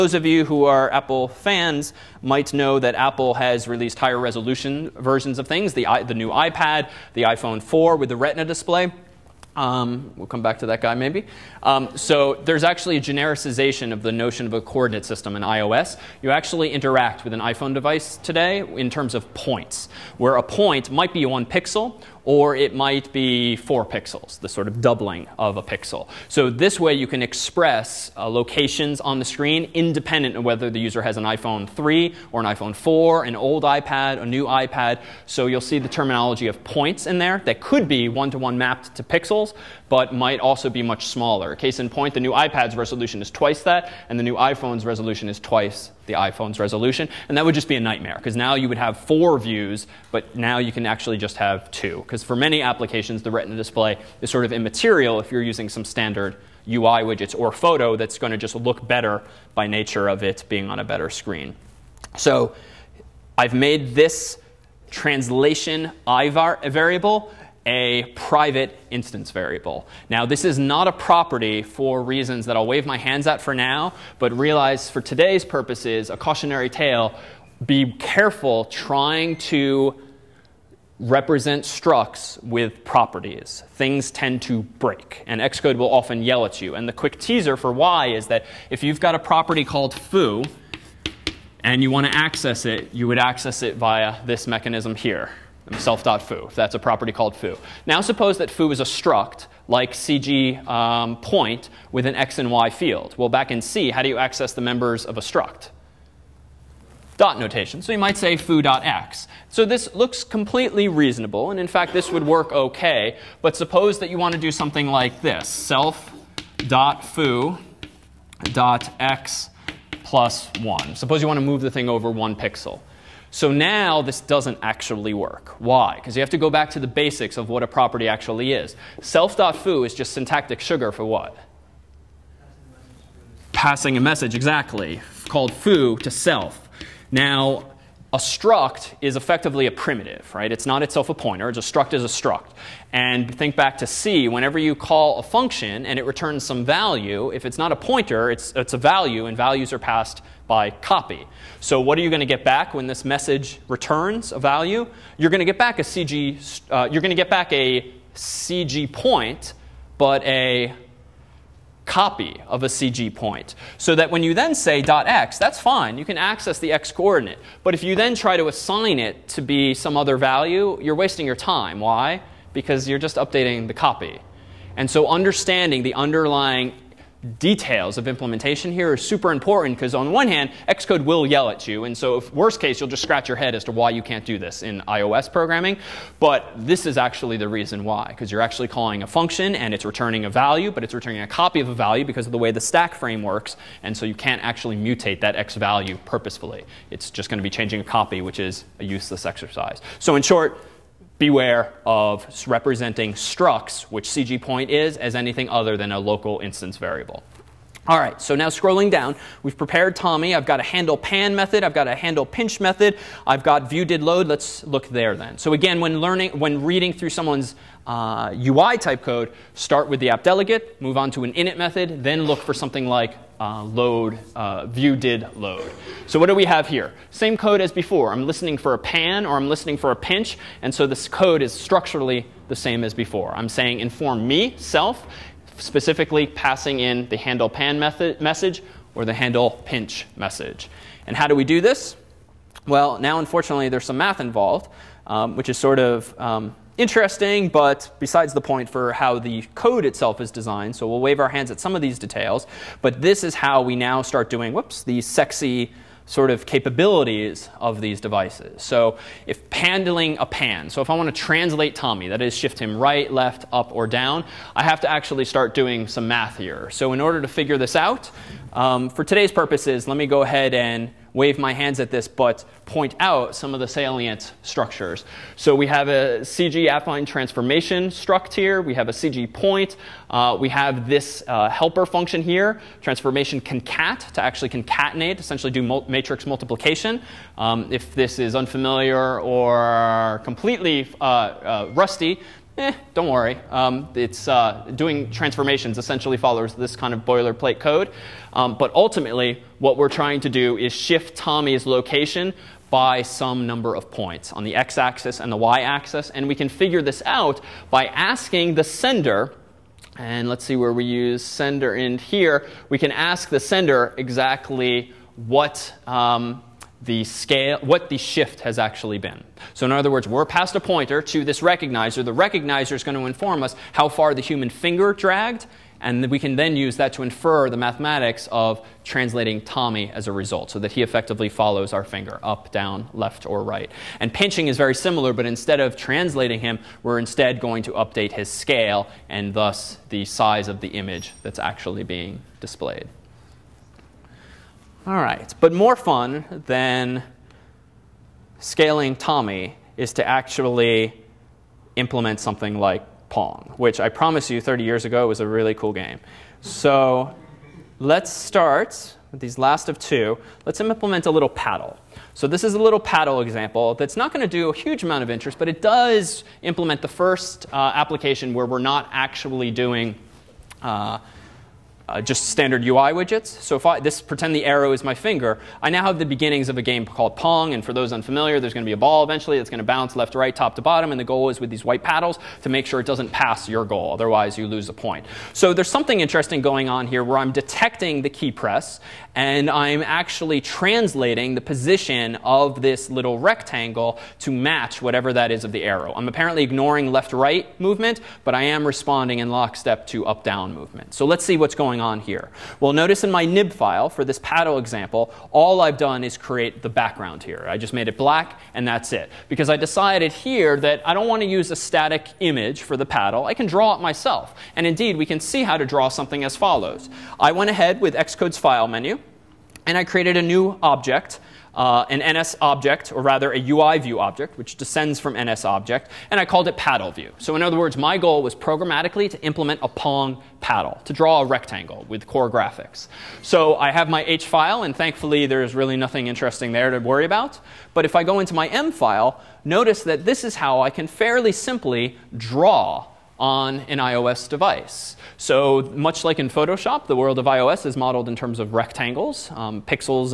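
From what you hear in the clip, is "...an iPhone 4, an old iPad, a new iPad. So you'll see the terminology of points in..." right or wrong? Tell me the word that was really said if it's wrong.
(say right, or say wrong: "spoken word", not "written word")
right.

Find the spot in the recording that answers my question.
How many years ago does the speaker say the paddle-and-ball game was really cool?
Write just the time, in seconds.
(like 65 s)
354 s.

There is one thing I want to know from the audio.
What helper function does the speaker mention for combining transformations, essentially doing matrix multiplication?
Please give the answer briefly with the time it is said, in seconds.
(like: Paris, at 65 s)
Transformation concat, at 282 s.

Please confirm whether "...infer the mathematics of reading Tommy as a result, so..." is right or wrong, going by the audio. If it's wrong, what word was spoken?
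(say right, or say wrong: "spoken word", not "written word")
wrong: "translating", not "reading".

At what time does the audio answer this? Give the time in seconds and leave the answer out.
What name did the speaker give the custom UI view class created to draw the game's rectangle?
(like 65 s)
426 s.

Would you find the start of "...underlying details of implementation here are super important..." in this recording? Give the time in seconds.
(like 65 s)
175 s.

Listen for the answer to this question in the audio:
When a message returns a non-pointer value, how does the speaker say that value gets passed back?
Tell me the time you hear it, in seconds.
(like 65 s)
149 s.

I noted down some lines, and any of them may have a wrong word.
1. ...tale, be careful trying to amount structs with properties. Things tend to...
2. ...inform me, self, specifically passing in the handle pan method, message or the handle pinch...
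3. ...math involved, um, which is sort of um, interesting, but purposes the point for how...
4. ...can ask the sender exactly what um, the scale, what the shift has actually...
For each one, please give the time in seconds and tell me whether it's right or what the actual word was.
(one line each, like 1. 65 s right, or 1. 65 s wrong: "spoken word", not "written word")
1. 76 s wrong: "represent", not "amount"
2. 233 s right
3. 243 s wrong: "besides", not "purposes"
4. 312 s right.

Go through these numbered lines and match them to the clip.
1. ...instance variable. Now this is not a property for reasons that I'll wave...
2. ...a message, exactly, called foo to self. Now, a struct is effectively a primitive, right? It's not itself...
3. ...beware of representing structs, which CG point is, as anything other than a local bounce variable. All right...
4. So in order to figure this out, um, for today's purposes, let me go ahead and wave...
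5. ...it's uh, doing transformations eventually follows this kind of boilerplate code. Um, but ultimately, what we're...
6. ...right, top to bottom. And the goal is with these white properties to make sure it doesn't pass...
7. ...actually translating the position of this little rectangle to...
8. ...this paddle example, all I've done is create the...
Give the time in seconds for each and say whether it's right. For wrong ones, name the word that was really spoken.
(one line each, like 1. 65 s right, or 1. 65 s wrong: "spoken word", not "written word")
1. 68 s right
2. 133 s right
3. 201 s wrong: "instance", not "bounce"
4. 266 s right
5. 293 s wrong: "essentially", not "eventually"
6. 380 s wrong: "paddles", not "properties"
7. 389 s right
8. 404 s right.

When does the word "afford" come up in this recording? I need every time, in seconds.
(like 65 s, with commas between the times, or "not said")
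not said.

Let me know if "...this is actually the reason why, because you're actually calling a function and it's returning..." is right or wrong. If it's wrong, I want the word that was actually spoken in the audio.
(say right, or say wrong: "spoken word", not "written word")
right.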